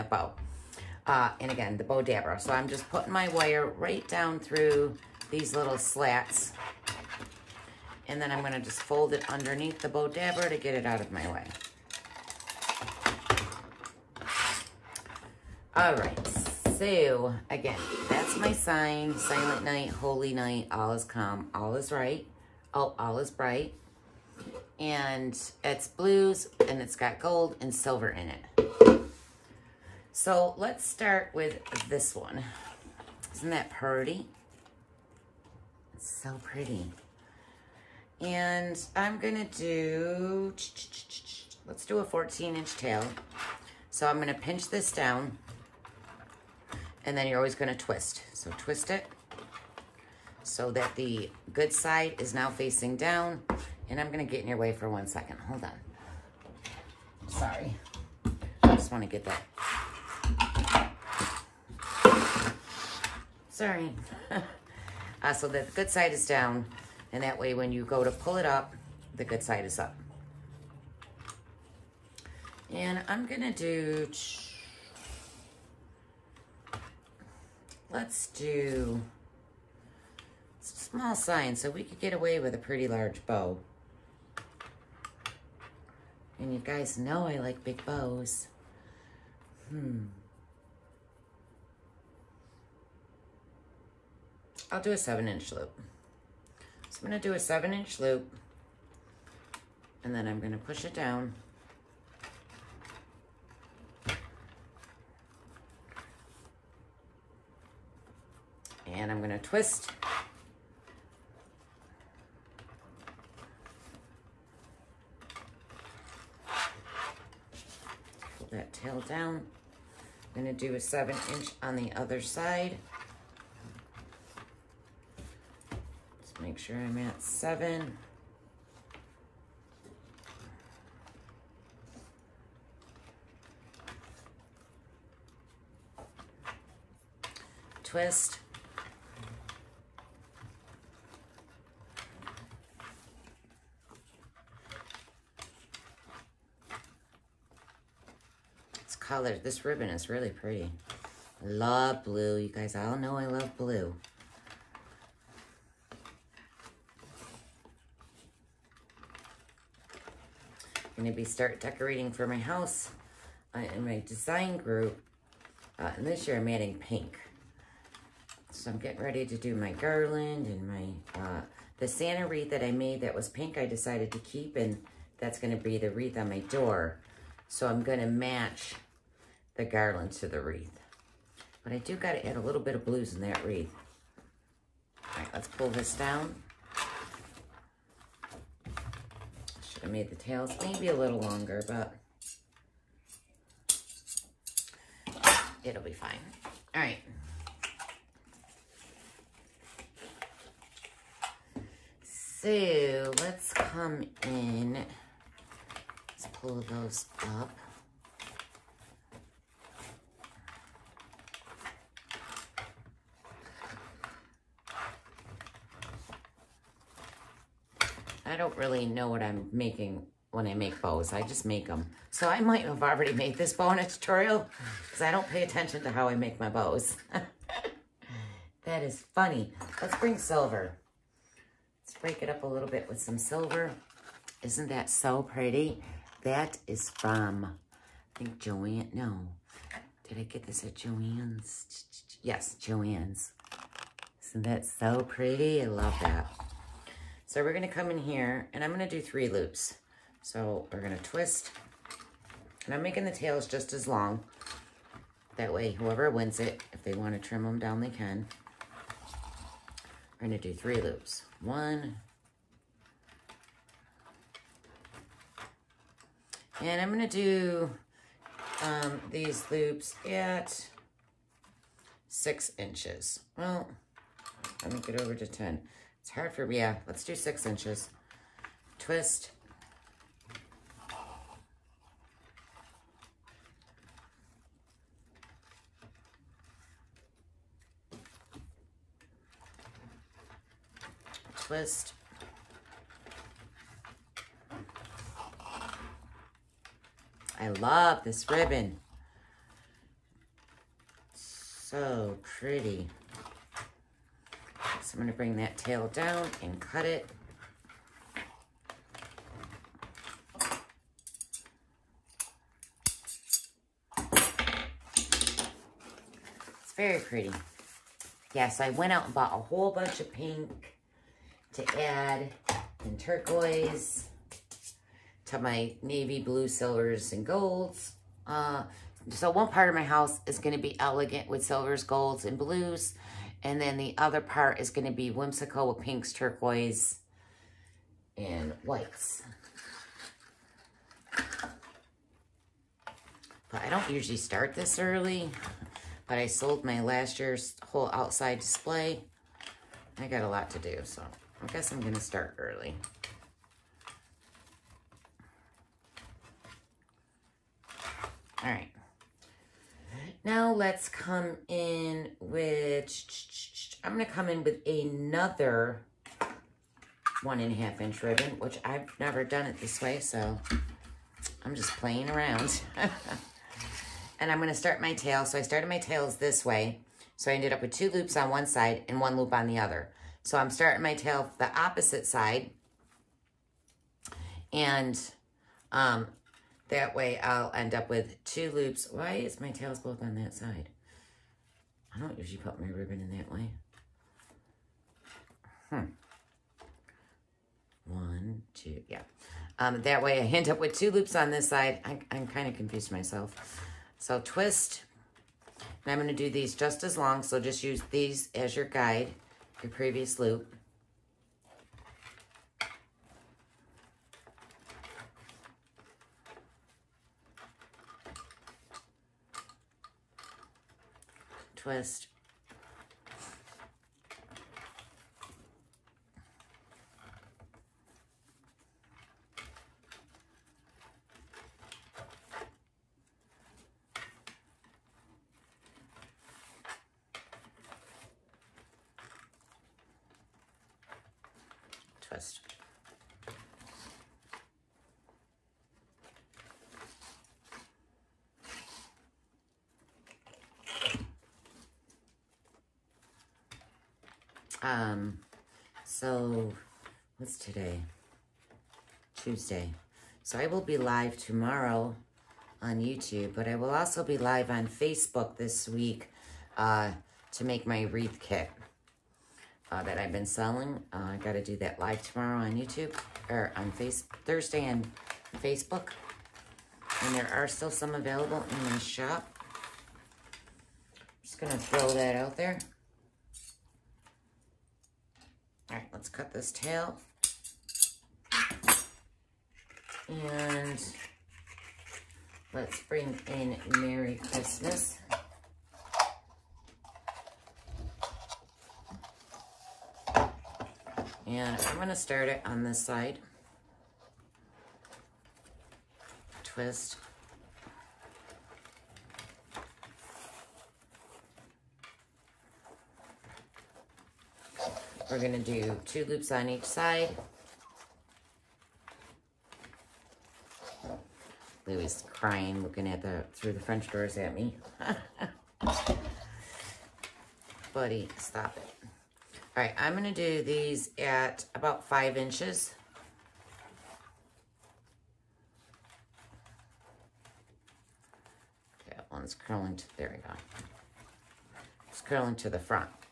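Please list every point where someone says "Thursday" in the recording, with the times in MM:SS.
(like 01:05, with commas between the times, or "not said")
07:54.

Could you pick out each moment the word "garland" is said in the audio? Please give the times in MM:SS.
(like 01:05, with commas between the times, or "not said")
02:49, 02:59.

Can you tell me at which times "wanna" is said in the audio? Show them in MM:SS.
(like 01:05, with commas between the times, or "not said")
00:58, 04:16.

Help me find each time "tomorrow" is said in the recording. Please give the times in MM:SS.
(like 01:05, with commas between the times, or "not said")
07:41, 07:52.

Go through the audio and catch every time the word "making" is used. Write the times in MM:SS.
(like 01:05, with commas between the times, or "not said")
03:39, 04:12.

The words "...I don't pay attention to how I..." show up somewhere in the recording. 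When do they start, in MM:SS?
03:45.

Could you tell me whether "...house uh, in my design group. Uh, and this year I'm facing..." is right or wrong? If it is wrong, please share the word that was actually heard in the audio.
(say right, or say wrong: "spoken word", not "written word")
wrong: "adding", not "facing".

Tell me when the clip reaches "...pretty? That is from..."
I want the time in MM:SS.
03:55.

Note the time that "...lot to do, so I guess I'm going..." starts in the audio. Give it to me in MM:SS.
05:50.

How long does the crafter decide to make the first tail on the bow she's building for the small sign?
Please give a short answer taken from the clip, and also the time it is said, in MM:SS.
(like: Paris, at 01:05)
14 inch, at 00:42.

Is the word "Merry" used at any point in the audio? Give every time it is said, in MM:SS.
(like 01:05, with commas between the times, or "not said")
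08:13.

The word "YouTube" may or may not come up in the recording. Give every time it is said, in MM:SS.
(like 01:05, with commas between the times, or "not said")
07:42, 07:52.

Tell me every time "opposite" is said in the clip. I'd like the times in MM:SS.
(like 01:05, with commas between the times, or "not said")
06:21.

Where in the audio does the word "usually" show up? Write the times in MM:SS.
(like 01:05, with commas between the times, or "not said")
05:43, 06:32.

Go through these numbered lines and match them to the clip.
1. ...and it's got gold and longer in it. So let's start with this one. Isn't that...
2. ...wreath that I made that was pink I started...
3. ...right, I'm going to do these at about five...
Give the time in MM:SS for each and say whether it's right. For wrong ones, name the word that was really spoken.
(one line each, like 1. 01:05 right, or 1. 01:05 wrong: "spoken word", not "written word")
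1. 00:26 wrong: "silver", not "longer"
2. 02:52 wrong: "decided", not "started"
3. 08:49 right.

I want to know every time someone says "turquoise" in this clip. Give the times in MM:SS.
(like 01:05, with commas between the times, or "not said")
05:22, 05:36.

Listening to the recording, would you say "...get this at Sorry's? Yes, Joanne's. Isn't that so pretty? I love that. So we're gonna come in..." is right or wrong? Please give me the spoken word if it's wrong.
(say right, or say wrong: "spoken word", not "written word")
wrong: "Joanne", not "Sorry".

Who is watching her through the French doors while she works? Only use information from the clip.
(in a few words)
Louis.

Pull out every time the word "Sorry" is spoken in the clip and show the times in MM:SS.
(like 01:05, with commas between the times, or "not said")
00:57, 01:03.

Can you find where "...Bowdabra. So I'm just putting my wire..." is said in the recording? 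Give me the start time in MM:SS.
00:01.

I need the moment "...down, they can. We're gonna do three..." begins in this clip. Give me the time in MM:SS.
04:17.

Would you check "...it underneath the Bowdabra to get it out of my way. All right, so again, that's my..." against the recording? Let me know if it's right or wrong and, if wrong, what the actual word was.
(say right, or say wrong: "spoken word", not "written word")
right.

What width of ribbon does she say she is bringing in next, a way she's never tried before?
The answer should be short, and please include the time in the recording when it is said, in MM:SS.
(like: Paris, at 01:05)
1.5 inch, at 06:07.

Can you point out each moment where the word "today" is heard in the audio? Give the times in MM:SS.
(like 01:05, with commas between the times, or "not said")
07:37.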